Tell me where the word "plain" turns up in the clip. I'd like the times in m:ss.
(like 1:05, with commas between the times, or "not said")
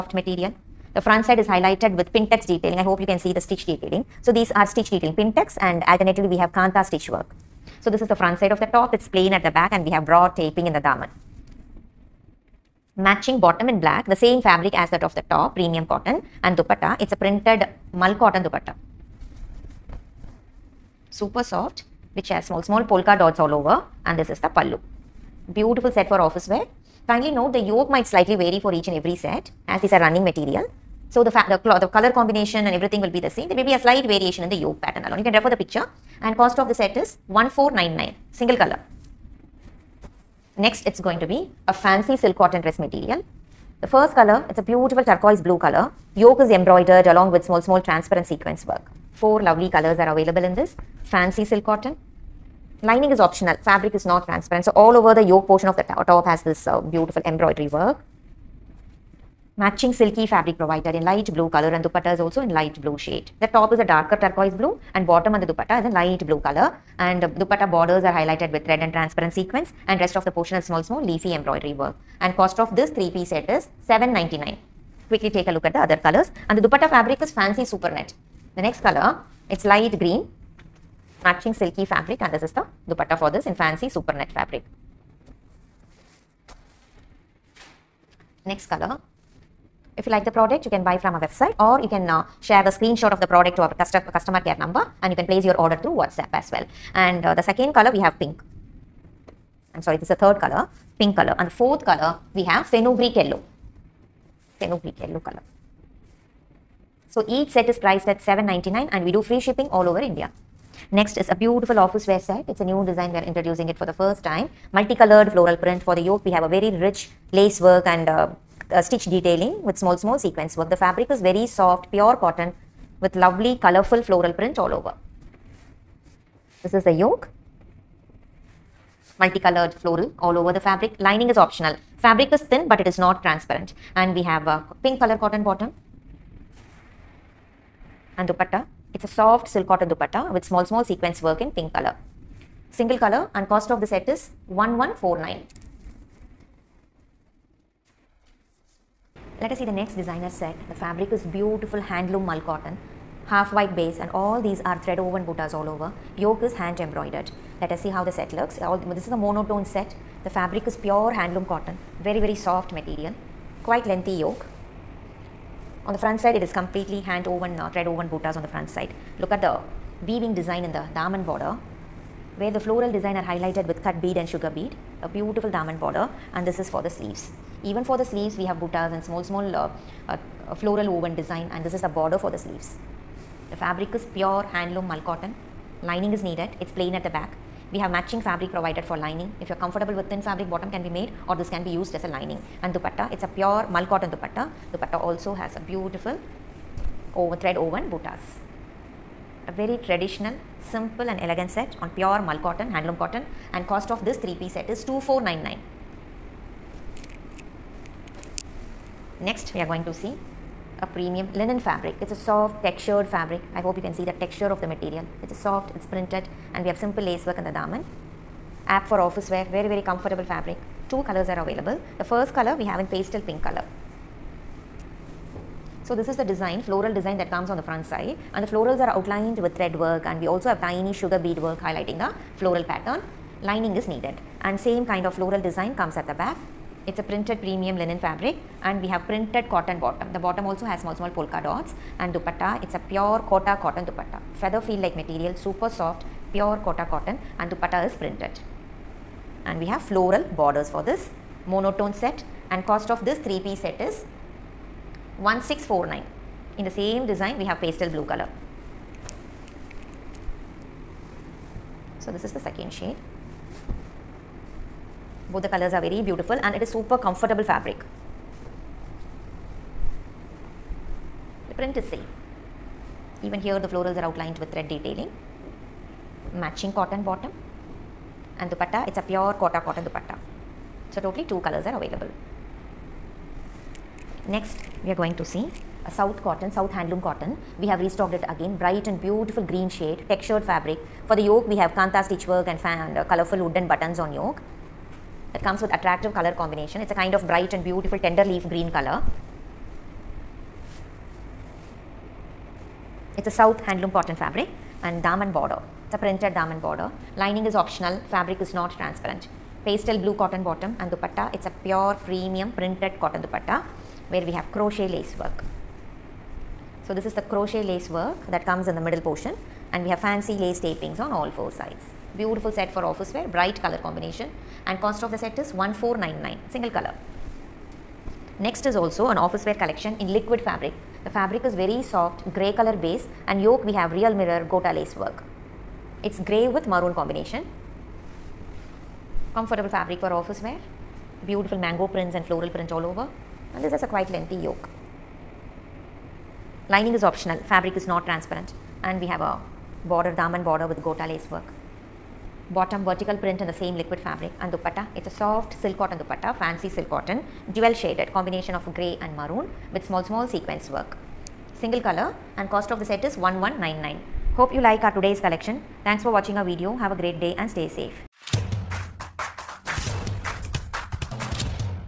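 0:09, 3:06.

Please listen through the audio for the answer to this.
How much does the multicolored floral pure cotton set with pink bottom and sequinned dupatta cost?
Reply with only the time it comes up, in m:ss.
2:24.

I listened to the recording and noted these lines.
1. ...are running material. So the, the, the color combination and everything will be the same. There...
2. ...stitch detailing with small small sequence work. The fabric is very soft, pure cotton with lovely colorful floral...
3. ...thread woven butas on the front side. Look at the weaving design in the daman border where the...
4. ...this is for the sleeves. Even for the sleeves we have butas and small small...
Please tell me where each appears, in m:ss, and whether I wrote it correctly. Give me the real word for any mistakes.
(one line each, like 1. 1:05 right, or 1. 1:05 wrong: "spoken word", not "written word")
1. 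0:29 right
2. 1:58 right
3. 2:47 right
4. 2:56 right.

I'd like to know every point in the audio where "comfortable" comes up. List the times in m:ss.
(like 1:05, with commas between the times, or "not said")
3:09, 3:39, 4:26, 5:39.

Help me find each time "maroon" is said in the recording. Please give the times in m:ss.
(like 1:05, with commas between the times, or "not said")
5:36, 5:59.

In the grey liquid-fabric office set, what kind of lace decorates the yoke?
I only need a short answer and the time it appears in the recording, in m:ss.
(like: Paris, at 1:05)
real mirror gota lace, at 5:33.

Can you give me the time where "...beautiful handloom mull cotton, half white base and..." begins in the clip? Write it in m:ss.
2:31.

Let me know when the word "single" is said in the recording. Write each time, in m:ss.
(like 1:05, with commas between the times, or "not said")
0:38, 2:22, 5:26, 6:01.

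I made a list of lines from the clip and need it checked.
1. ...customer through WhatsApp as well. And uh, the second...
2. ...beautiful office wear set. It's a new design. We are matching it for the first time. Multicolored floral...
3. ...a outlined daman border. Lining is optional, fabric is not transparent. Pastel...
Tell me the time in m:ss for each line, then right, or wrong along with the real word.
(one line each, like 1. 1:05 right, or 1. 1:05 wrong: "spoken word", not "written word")
1. 1:35 wrong: "order", not "customer"
2. 1:51 wrong: "introducing", not "matching"
3. 5:05 wrong: "printed", not "outlined".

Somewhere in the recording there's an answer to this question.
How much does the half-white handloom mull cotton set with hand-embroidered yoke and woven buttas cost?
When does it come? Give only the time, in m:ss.
3:24.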